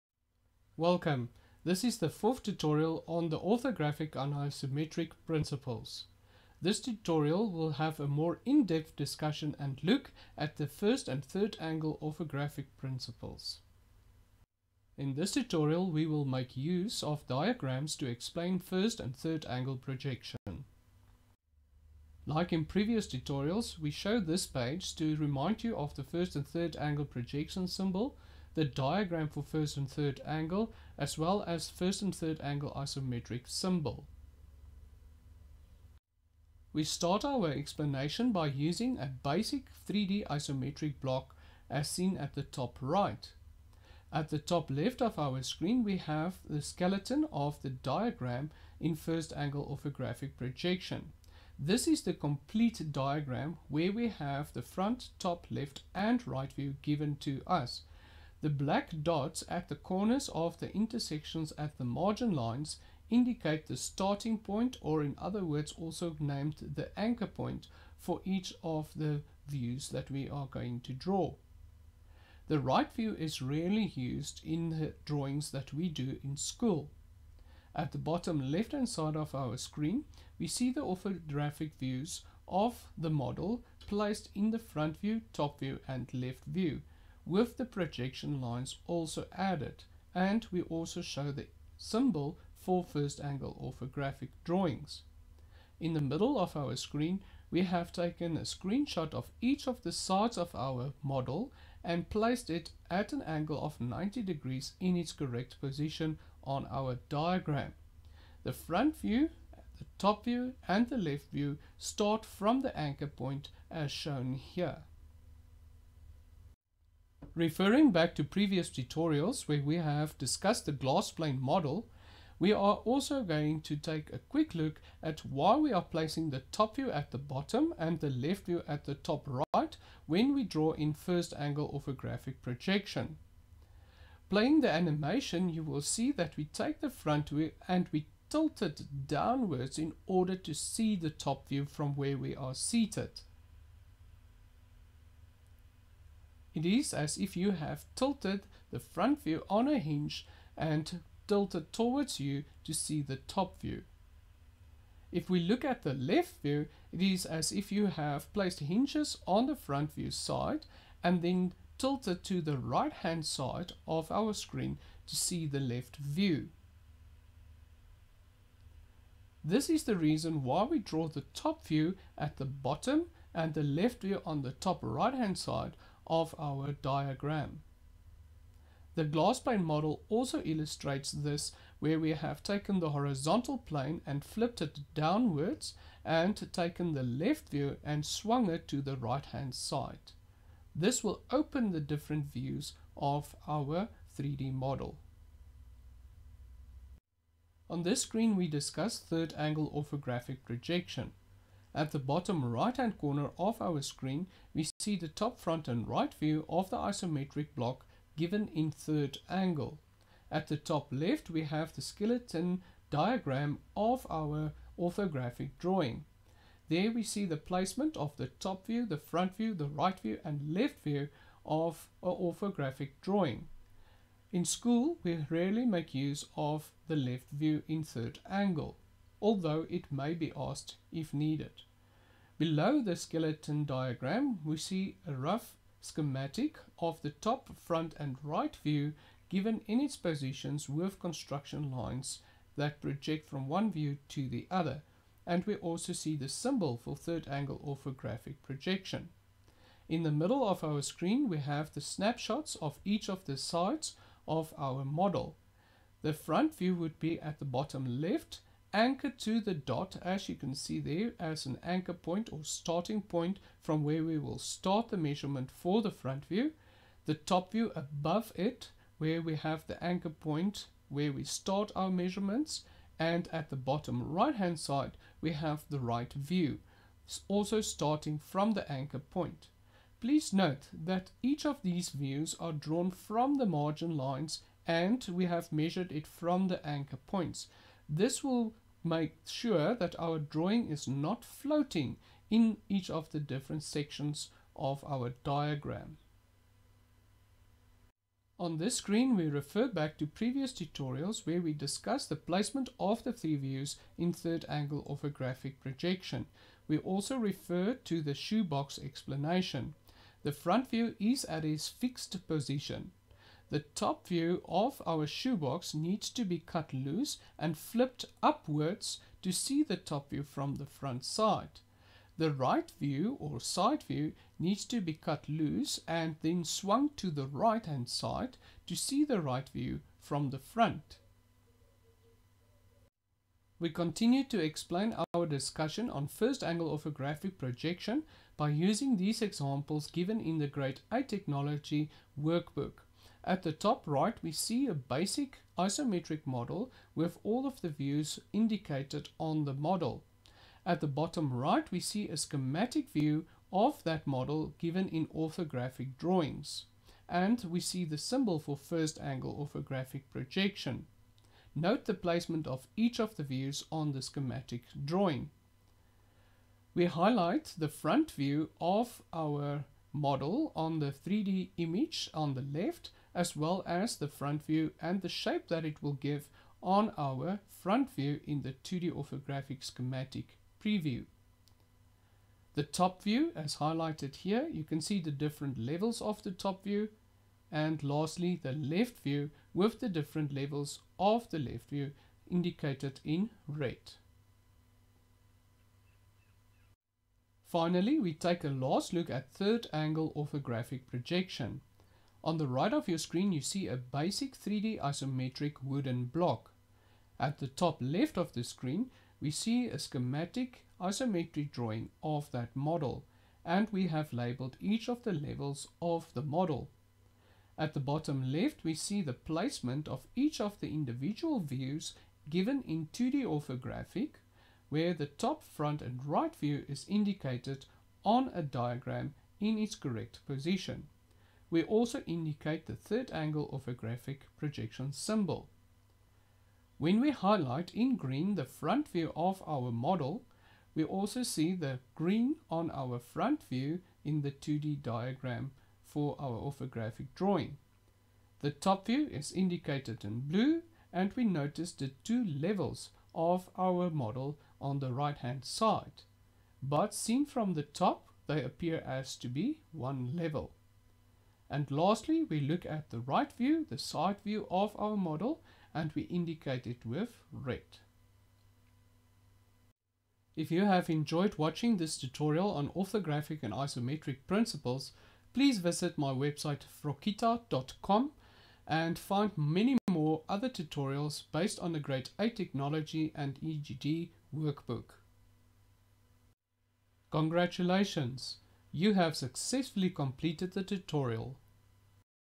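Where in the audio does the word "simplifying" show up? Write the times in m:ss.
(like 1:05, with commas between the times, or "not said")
not said.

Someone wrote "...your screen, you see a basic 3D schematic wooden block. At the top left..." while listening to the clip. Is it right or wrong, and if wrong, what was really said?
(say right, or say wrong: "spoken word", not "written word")
wrong: "isometric", not "schematic".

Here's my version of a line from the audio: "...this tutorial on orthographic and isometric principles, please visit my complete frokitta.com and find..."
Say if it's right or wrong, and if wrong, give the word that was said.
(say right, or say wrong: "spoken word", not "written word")
wrong: "website", not "complete".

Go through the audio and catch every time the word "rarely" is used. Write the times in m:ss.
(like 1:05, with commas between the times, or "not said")
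1:13, 3:45.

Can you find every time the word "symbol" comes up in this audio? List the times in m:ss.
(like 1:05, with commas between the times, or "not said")
0:27, 0:33, 1:31, 4:06, 5:57, 7:14.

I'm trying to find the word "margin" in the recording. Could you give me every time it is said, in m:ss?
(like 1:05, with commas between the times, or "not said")
1:01, 4:43.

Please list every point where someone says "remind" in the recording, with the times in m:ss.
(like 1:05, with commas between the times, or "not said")
0:25.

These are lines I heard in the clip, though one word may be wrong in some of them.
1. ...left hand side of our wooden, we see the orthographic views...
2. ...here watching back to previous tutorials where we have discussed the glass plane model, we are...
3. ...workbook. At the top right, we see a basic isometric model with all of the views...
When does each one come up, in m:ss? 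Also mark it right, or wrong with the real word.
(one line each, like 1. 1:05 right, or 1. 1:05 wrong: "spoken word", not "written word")
1. 1:18 wrong: "screen", not "wooden"
2. 1:54 wrong: "referring", not "watching"
3. 5:42 right.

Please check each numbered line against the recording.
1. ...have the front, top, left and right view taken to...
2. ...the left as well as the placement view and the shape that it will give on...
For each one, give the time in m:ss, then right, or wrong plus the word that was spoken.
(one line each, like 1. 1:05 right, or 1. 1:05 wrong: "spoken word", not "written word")
1. 0:54 wrong: "given", not "taken"
2. 6:12 wrong: "front", not "placement".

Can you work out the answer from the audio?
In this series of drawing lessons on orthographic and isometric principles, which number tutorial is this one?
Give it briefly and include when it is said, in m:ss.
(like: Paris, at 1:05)
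fourth, at 0:02.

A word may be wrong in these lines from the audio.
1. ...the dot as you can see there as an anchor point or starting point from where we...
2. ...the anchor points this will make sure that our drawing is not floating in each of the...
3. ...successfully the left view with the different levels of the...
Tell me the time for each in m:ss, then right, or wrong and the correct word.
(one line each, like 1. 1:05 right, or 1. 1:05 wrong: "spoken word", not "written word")
1. 4:19 right
2. 4:46 right
3. 6:27 wrong: "lastly", not "successfully".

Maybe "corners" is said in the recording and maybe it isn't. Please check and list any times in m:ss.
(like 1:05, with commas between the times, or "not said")
0:59, 3:22.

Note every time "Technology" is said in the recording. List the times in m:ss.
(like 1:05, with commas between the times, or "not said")
5:41, 8:02.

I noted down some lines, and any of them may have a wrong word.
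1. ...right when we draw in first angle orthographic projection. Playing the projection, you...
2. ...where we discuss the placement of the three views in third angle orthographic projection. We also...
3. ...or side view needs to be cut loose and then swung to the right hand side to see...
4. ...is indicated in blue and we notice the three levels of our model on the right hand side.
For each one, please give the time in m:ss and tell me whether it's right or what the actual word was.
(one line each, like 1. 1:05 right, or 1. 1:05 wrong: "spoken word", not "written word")
1. 2:09 wrong: "animation", not "projection"
2. 5:01 right
3. 5:23 right
4. 7:29 wrong: "two", not "three".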